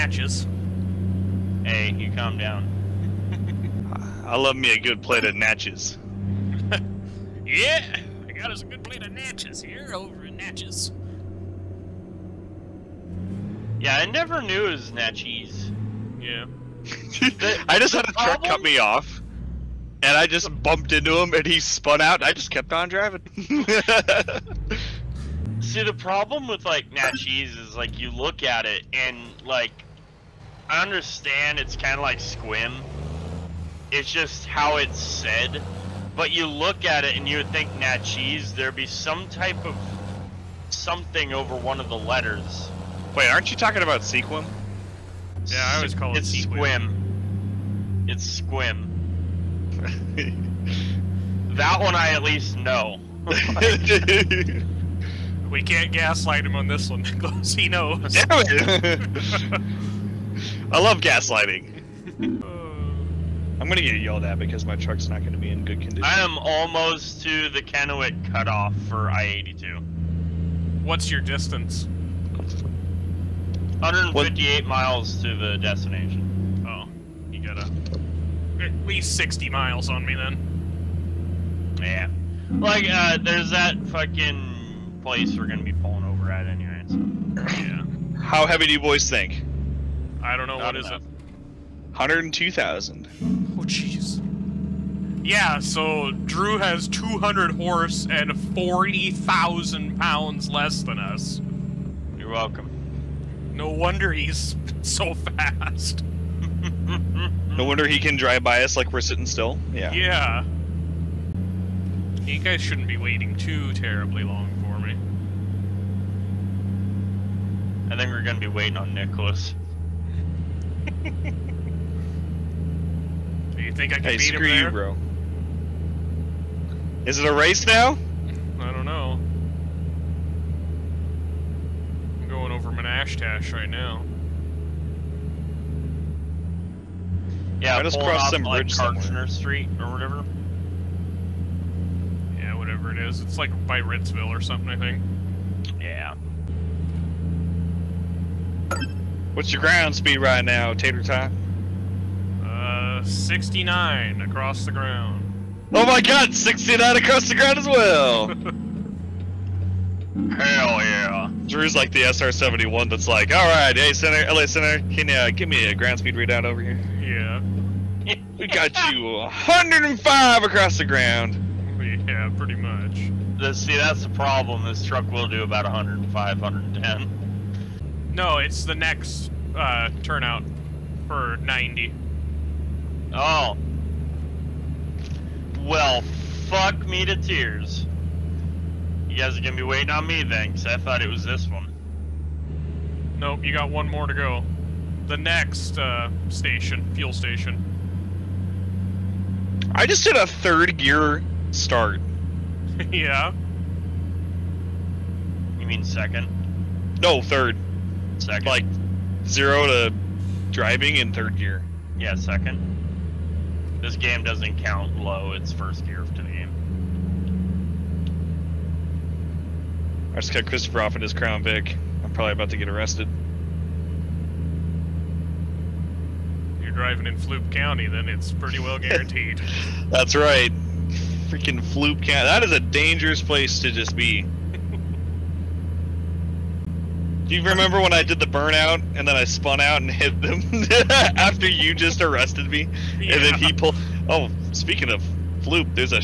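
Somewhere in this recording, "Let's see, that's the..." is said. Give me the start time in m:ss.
2:53.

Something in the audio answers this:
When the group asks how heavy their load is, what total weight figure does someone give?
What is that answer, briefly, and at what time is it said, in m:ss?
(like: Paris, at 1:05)
102,000, at 1:31.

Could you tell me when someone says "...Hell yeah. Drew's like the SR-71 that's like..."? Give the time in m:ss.
2:40.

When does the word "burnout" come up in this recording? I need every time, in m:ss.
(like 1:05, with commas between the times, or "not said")
3:58.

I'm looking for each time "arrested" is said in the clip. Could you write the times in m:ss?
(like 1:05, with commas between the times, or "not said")
3:42, 4:02.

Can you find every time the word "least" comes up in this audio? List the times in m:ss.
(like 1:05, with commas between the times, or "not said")
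0:52, 1:18.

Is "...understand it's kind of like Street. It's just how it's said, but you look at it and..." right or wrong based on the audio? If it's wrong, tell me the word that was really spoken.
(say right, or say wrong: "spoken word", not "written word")
wrong: "Squim", not "Street".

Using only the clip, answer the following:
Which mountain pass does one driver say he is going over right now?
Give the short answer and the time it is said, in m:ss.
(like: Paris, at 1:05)
Manastash, at 2:12.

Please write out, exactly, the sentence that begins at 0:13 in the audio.
Yeah, I never knew it was Natchez.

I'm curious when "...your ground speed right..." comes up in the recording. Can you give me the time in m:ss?
2:29.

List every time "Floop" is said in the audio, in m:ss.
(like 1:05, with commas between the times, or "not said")
3:47, 3:51, 4:05.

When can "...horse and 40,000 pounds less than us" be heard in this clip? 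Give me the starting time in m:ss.
1:37.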